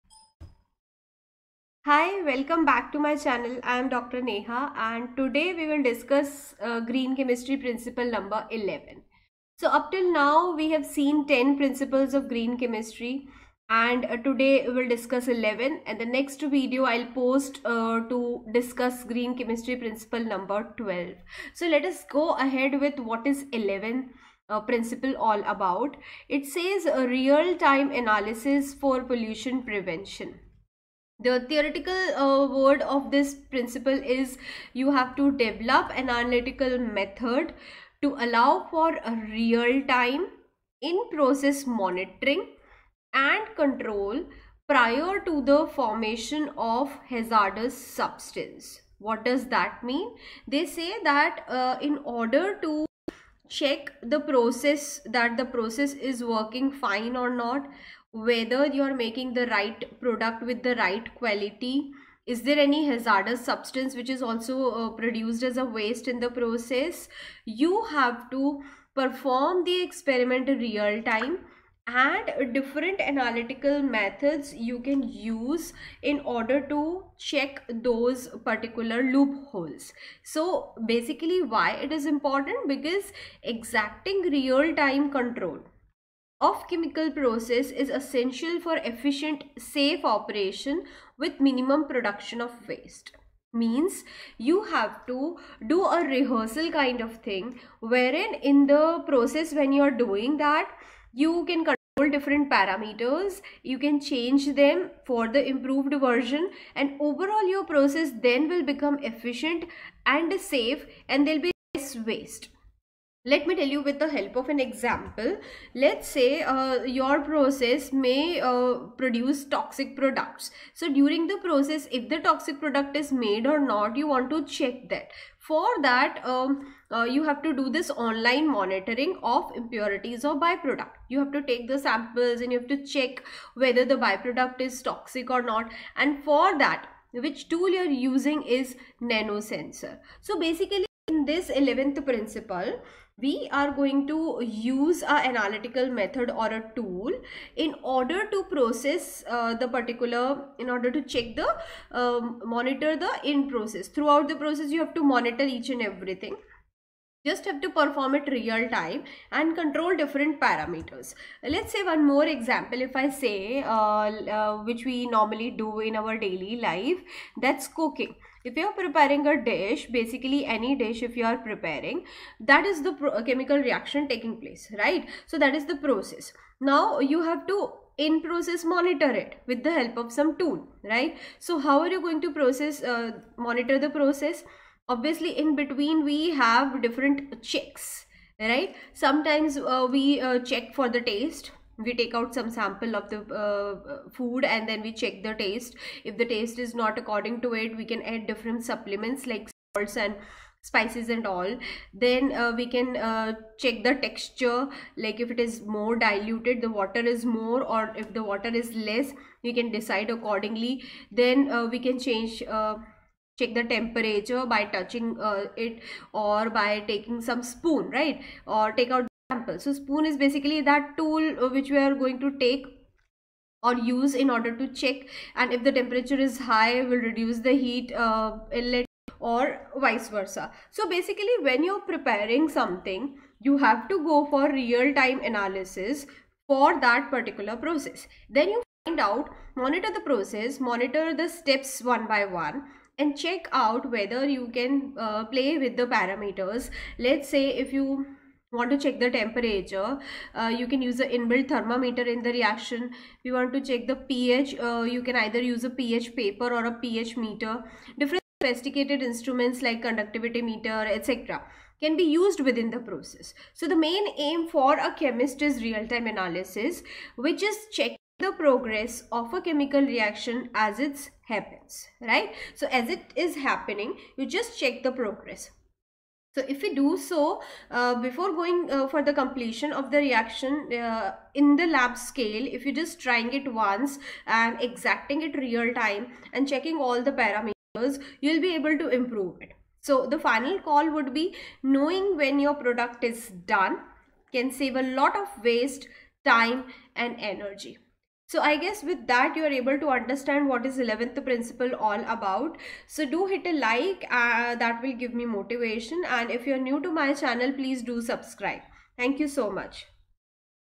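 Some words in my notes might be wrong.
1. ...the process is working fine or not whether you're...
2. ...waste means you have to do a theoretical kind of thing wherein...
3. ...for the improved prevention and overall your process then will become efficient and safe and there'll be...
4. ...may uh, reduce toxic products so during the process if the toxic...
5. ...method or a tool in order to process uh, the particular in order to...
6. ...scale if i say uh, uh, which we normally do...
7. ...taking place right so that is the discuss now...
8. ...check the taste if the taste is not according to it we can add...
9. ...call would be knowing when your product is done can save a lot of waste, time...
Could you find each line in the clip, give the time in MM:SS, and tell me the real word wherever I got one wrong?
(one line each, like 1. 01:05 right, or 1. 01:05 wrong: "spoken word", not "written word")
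1. 00:55 right
2. 01:32 wrong: "rehearsal", not "theoretical"
3. 01:45 wrong: "version", not "prevention"
4. 01:57 wrong: "produce", not "reduce"
5. 02:25 right
6. 02:42 wrong: "example", not "scale"
7. 02:54 wrong: "process", not "discuss"
8. 03:15 right
9. 04:50 right.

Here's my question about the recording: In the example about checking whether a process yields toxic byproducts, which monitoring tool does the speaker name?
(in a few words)
Nanosensor.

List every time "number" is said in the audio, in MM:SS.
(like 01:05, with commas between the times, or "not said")
00:08, 00:20.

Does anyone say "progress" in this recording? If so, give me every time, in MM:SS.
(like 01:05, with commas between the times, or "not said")
04:28, 04:34.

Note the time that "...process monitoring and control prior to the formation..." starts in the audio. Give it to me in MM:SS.
00:41.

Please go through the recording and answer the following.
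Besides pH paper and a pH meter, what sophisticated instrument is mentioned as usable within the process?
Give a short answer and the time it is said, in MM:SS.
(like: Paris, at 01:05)
Conductivity meter, at 04:19.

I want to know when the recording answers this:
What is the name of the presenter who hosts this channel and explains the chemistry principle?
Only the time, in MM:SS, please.
00:03.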